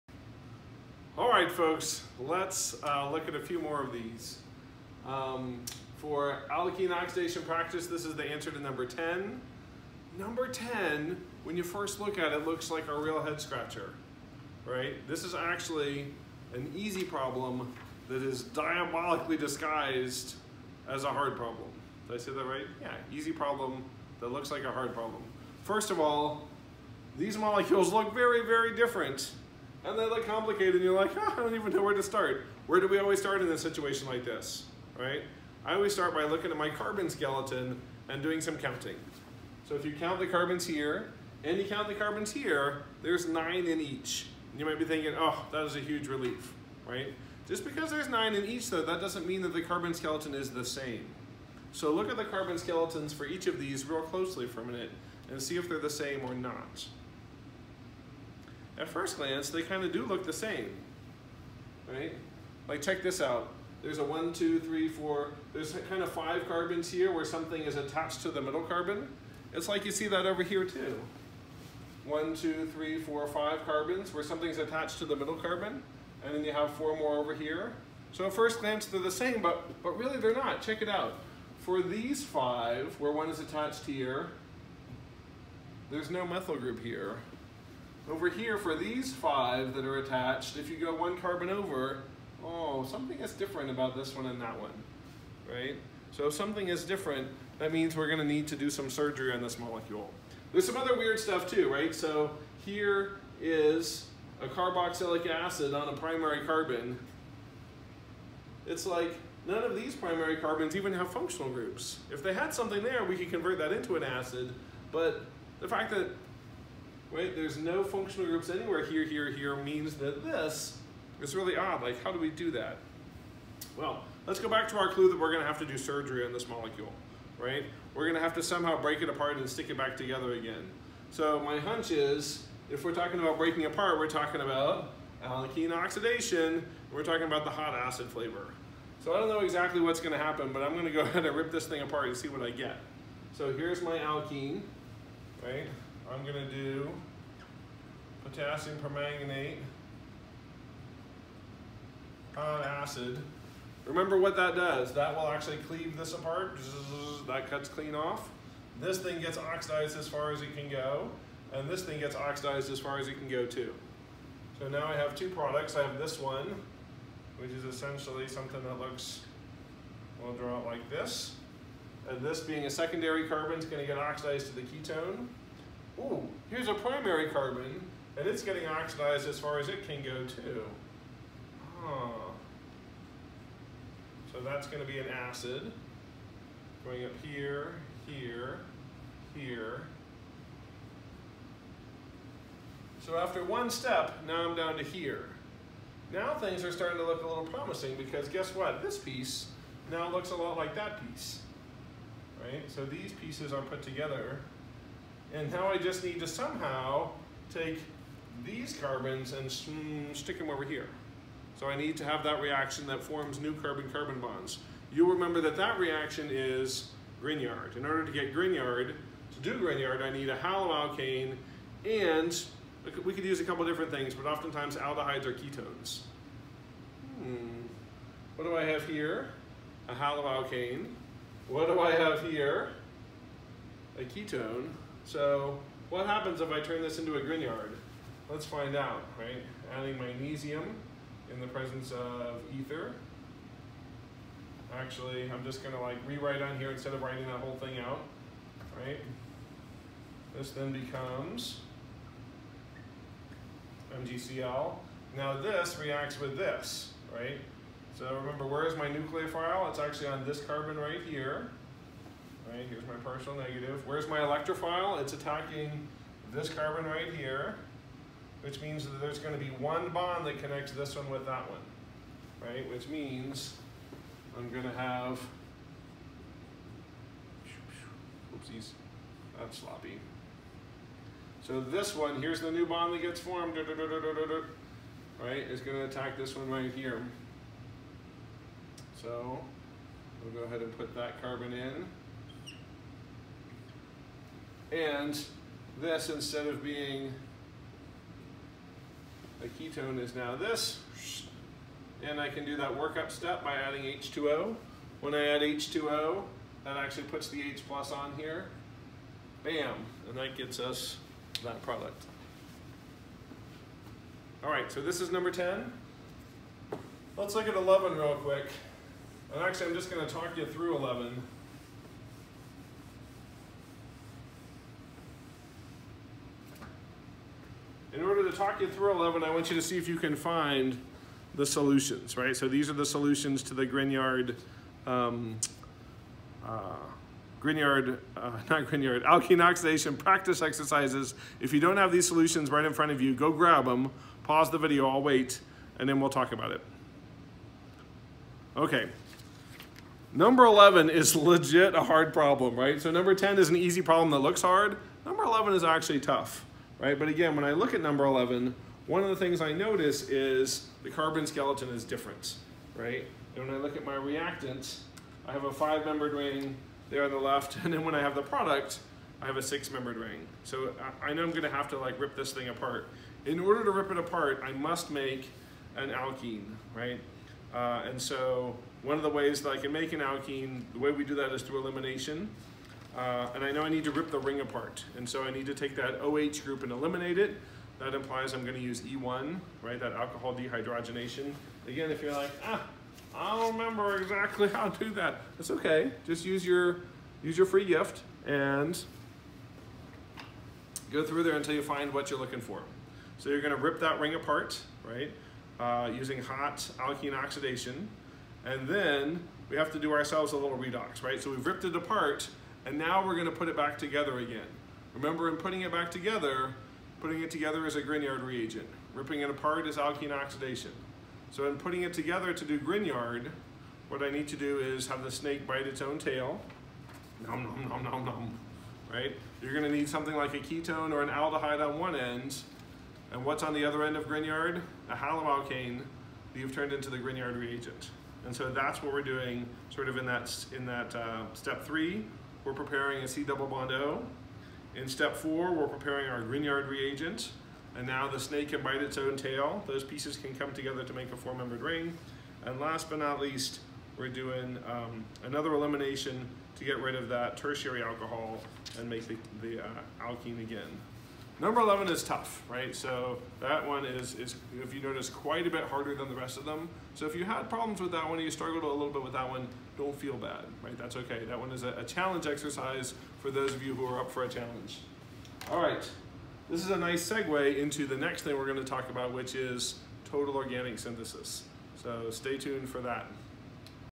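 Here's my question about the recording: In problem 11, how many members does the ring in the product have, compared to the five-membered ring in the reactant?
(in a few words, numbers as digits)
6.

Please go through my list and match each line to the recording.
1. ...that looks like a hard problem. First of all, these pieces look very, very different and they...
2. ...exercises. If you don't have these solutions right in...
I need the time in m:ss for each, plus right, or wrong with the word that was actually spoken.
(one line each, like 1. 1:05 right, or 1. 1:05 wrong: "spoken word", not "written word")
1. 0:24 wrong: "molecules", not "pieces"
2. 5:40 right.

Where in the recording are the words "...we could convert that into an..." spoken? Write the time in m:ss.
1:53.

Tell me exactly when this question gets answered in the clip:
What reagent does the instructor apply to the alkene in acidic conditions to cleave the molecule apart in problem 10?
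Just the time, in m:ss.
2:28.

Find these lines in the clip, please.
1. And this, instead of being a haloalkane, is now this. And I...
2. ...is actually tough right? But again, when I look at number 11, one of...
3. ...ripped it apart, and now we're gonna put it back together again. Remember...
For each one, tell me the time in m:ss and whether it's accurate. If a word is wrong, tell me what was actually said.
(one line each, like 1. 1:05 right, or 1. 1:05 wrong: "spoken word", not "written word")
1. 4:54 wrong: "ketone", not "haloalkane"
2. 5:55 right
3. 6:51 right.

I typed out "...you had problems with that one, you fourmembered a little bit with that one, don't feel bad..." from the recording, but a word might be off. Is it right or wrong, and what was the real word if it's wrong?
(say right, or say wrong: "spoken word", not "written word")
wrong: "struggled", not "fourmembered".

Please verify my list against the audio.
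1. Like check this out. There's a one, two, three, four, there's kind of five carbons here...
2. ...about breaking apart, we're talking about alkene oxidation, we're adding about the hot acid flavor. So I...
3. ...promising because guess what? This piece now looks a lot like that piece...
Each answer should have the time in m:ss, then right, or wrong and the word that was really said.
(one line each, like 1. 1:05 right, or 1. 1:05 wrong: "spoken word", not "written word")
1. 1:02 right
2. 2:13 wrong: "talking", not "adding"
3. 3:17 right.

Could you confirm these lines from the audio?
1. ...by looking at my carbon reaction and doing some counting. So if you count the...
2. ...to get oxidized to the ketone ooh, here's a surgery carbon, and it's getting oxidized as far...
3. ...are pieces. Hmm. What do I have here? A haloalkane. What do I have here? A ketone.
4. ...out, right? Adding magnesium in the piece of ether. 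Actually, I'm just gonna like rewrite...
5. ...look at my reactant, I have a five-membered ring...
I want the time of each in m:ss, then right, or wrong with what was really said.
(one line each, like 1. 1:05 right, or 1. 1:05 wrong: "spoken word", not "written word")
1. 0:36 wrong: "skeleton", not "reaction"
2. 2:53 wrong: "primary", not "surgery"
3. 3:45 wrong: "ketones", not "pieces"
4. 3:58 wrong: "presence", not "piece"
5. 6:03 right.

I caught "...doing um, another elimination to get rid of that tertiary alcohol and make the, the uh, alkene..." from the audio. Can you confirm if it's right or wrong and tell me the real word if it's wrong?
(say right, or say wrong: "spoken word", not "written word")
right.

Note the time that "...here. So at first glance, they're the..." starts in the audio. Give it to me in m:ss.
1:17.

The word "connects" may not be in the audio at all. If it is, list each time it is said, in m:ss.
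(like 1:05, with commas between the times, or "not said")
4:30.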